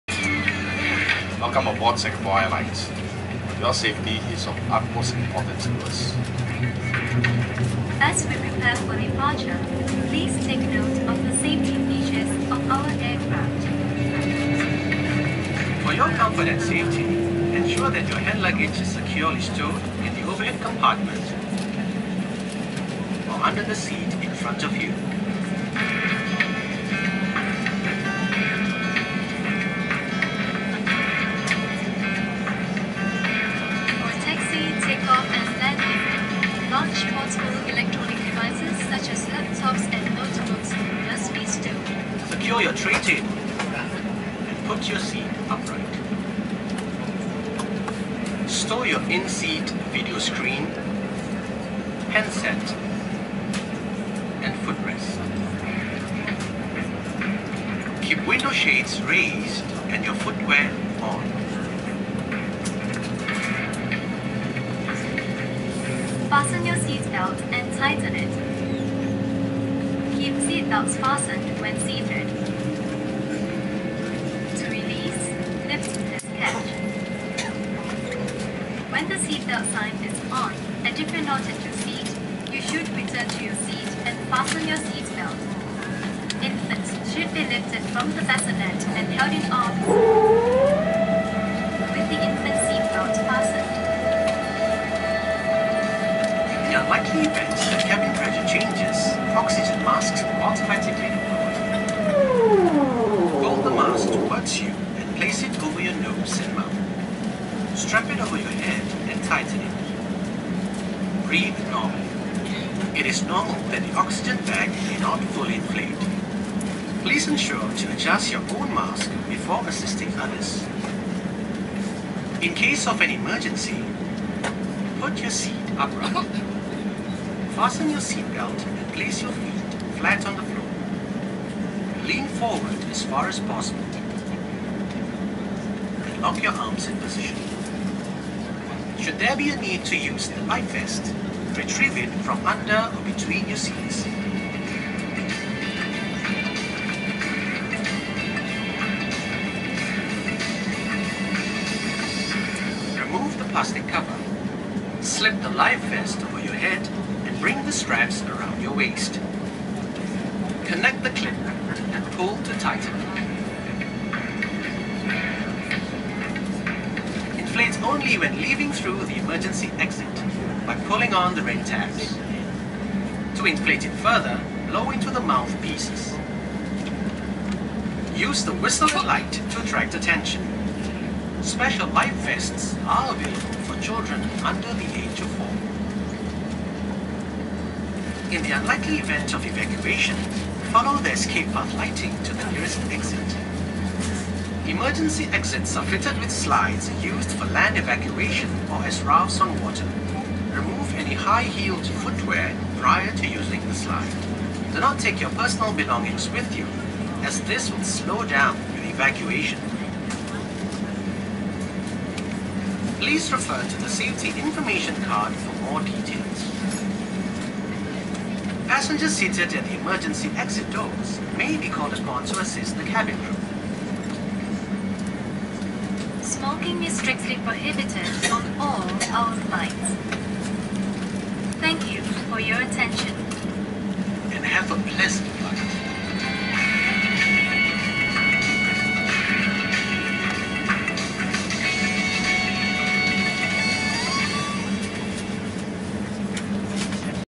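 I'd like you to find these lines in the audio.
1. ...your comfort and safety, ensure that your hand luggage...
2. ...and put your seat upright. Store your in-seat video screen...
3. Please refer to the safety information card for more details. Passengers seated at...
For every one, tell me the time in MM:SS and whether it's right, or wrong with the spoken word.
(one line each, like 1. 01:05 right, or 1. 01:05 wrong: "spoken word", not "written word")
1. 00:15 right
2. 00:43 right
3. 03:32 right.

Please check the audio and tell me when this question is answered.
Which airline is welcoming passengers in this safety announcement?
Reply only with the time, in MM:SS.
00:01.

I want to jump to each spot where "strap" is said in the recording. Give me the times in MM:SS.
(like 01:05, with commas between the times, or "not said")
01:47, 02:37.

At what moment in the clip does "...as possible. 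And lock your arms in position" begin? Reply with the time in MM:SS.
02:13.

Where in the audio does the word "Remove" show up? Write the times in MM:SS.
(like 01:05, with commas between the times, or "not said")
02:32, 03:20.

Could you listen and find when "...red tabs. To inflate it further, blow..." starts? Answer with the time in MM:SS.
02:51.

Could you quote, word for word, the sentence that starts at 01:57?
Please ensure to adjust your own mask before assisting others.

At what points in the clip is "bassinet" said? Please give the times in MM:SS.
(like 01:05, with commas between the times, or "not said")
01:28.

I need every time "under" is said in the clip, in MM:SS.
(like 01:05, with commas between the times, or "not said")
00:23, 02:22, 03:04.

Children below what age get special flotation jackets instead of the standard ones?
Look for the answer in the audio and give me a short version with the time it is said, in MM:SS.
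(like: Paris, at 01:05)
4, at 03:05.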